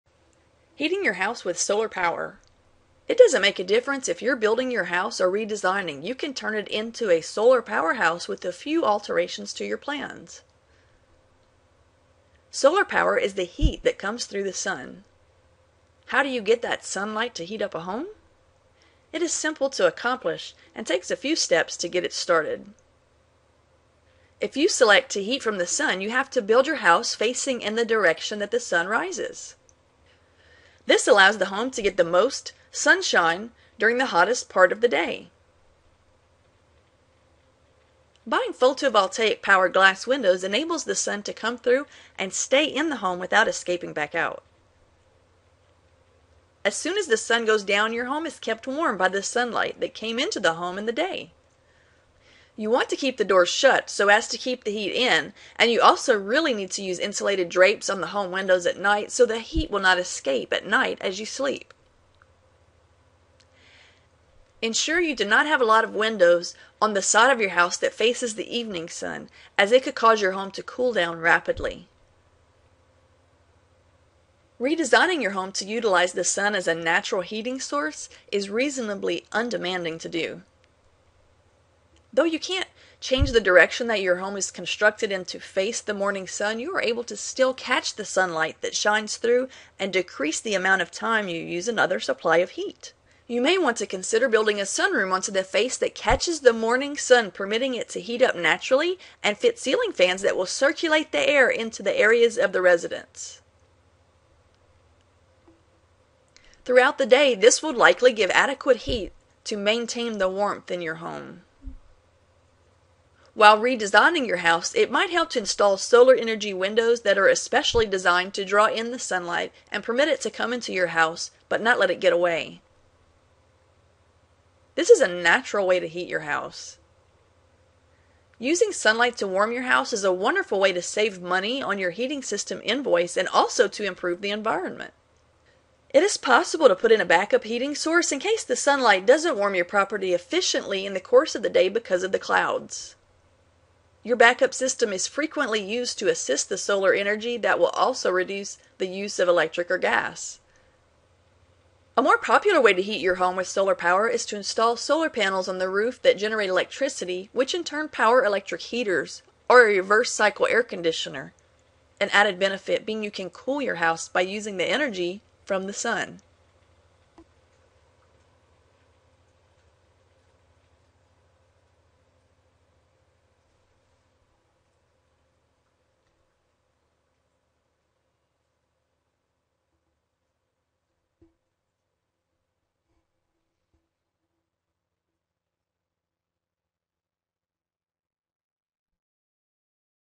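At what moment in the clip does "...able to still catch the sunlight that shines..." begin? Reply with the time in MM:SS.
01:26.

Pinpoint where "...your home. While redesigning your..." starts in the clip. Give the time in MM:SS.
01:50.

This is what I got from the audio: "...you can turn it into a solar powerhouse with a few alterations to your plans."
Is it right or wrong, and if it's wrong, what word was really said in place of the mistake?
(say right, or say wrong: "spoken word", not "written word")
right.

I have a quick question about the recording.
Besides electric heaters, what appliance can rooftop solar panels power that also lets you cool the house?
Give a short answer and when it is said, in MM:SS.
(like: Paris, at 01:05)
reverse cycle air conditioner, at 02:39.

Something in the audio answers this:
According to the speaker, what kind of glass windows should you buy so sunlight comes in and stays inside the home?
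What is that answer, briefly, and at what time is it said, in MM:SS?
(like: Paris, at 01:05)
photovoltaic powered glass windows, at 00:38.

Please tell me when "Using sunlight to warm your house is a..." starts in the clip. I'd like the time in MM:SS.
02:08.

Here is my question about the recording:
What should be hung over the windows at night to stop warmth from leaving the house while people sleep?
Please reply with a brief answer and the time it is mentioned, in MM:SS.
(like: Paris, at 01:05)
insulated drapes, at 00:56.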